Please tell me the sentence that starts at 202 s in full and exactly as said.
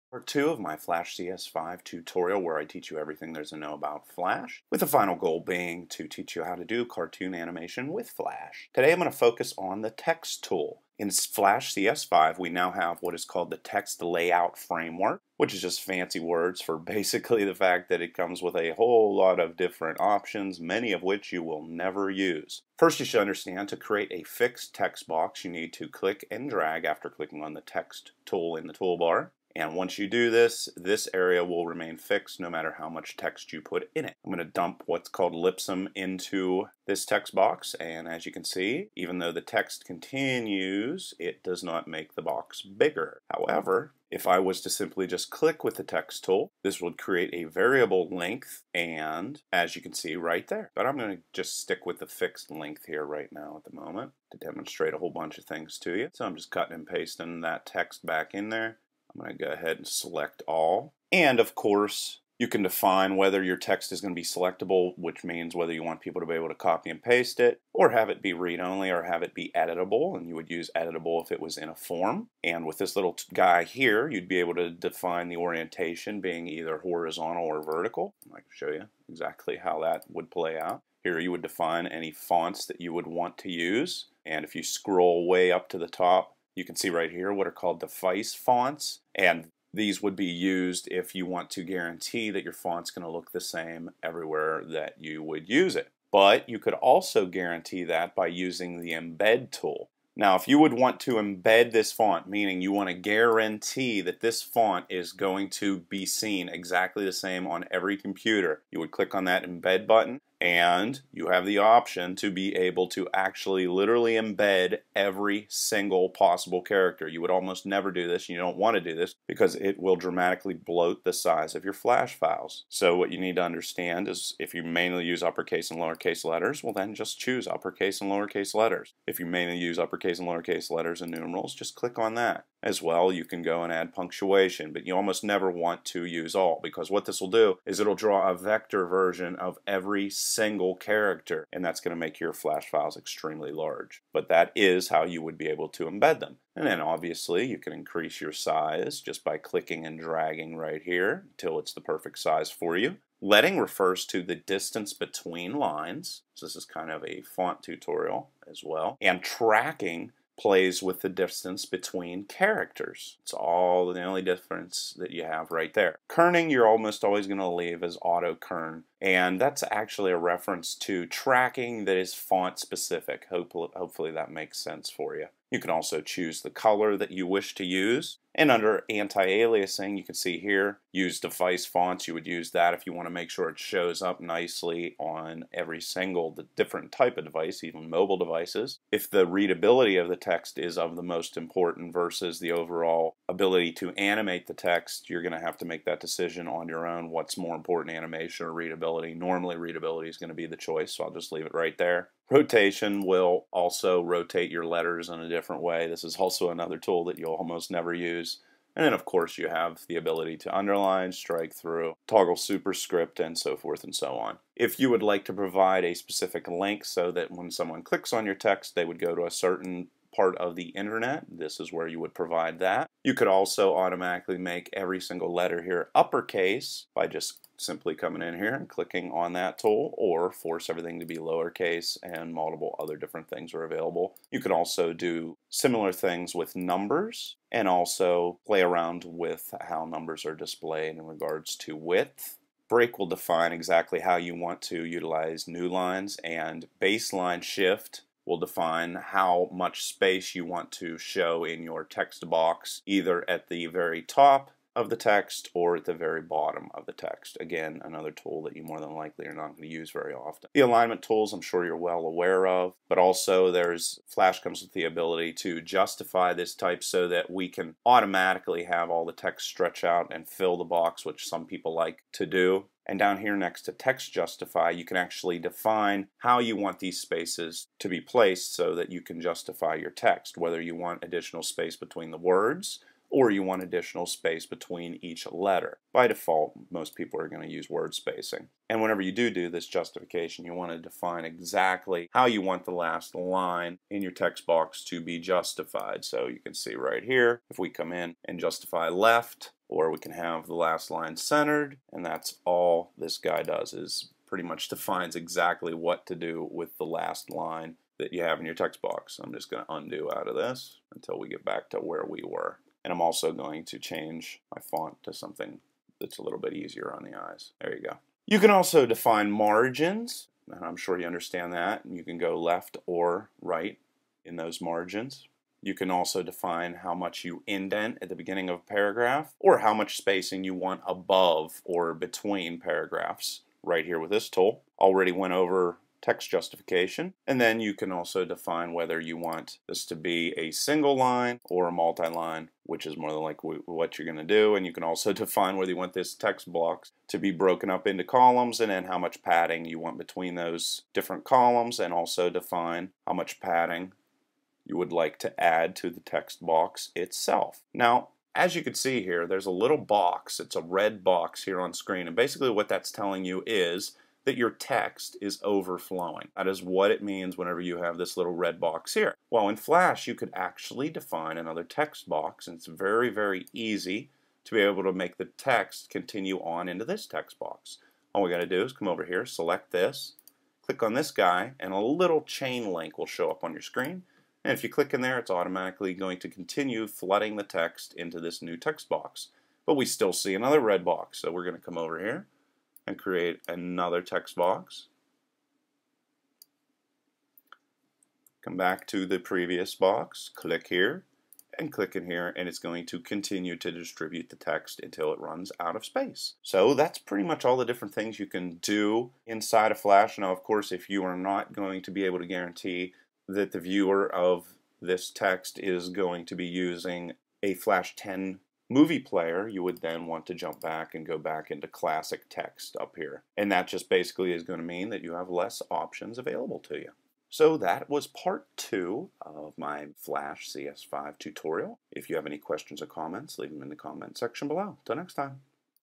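Rotation will also rotate your letters in a different way.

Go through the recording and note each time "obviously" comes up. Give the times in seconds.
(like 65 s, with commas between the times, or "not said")
146 s.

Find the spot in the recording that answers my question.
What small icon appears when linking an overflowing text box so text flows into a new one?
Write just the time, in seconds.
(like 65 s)
382 s.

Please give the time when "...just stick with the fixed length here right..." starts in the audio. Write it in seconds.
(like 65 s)
51 s.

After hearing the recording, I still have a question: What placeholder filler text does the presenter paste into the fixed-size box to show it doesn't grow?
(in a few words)
Lipsum.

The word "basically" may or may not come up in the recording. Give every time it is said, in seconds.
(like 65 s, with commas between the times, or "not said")
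16 s, 362 s, 423 s.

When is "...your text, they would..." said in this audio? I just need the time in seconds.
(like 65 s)
218 s.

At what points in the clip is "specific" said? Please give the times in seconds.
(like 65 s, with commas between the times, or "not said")
172 s, 215 s.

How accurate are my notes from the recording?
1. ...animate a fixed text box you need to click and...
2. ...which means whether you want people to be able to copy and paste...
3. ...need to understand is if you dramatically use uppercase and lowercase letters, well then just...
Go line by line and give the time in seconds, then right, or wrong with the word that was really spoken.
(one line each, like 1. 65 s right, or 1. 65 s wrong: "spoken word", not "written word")
1. 23 s wrong: "create", not "animate"
2. 64 s right
3. 123 s wrong: "mainly", not "dramatically".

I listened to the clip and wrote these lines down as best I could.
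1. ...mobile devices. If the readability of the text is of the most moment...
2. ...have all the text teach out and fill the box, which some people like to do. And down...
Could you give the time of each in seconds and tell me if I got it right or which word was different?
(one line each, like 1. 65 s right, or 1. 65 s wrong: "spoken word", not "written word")
1. 187 s wrong: "important", not "moment"
2. 268 s wrong: "stretch", not "teach".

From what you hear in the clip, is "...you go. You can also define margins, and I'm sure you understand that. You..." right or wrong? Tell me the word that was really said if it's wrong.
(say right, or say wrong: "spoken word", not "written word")
right.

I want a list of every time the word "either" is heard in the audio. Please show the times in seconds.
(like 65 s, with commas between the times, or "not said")
76 s, 252 s.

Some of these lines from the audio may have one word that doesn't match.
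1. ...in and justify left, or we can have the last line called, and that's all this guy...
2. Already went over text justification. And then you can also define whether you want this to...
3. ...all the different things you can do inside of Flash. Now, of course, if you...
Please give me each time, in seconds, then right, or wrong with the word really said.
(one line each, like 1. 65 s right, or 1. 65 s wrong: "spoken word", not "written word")
1. 297 s wrong: "centered", not "called"
2. 334 s right
3. 407 s right.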